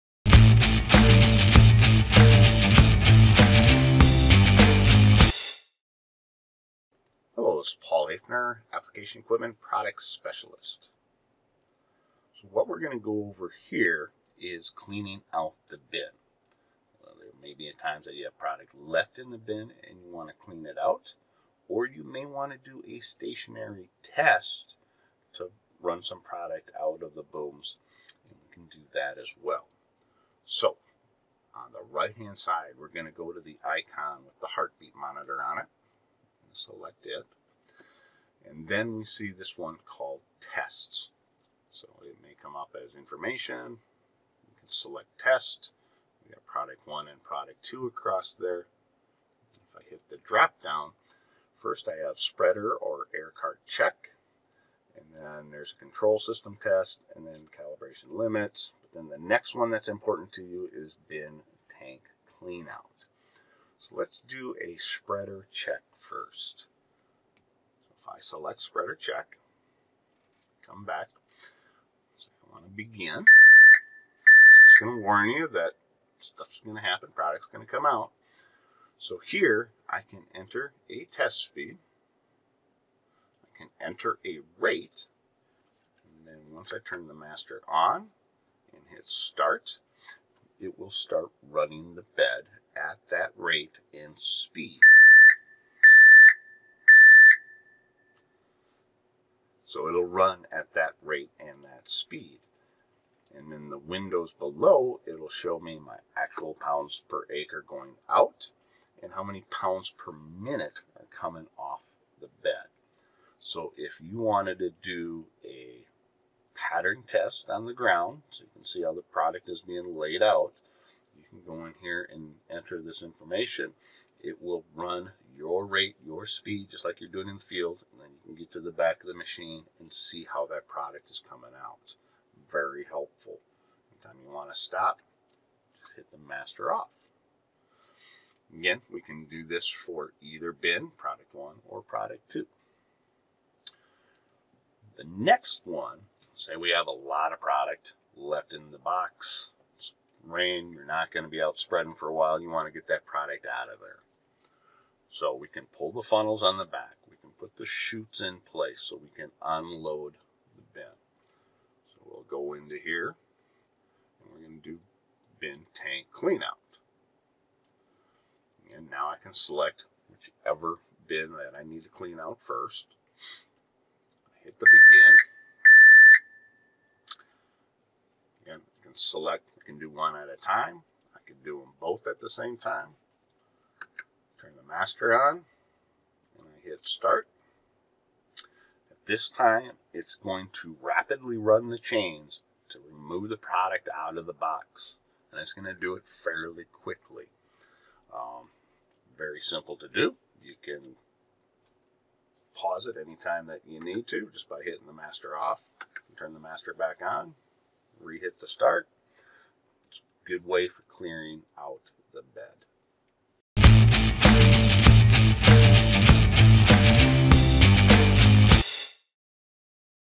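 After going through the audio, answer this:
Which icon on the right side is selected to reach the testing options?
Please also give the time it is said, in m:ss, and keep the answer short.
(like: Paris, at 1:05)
The heart, at 0:34.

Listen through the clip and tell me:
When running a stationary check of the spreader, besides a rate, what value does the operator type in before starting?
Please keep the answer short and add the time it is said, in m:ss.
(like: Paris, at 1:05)
Test speed, at 1:21.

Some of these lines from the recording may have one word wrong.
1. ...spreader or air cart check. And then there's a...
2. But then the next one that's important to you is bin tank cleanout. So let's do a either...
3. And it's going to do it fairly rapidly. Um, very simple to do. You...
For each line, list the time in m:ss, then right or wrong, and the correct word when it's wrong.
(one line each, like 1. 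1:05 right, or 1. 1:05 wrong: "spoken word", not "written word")
1. 0:52 right
2. 0:58 wrong: "spreader", not "either"
3. 3:15 wrong: "quickly", not "rapidly".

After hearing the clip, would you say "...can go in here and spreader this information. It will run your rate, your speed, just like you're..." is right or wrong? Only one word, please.
wrong.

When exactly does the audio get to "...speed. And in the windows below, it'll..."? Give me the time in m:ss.
1:41.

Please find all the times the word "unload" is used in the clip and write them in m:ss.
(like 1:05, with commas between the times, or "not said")
2:39.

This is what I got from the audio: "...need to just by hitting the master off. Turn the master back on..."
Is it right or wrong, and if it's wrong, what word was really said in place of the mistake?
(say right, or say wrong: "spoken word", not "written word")
right.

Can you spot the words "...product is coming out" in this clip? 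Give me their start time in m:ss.
2:10.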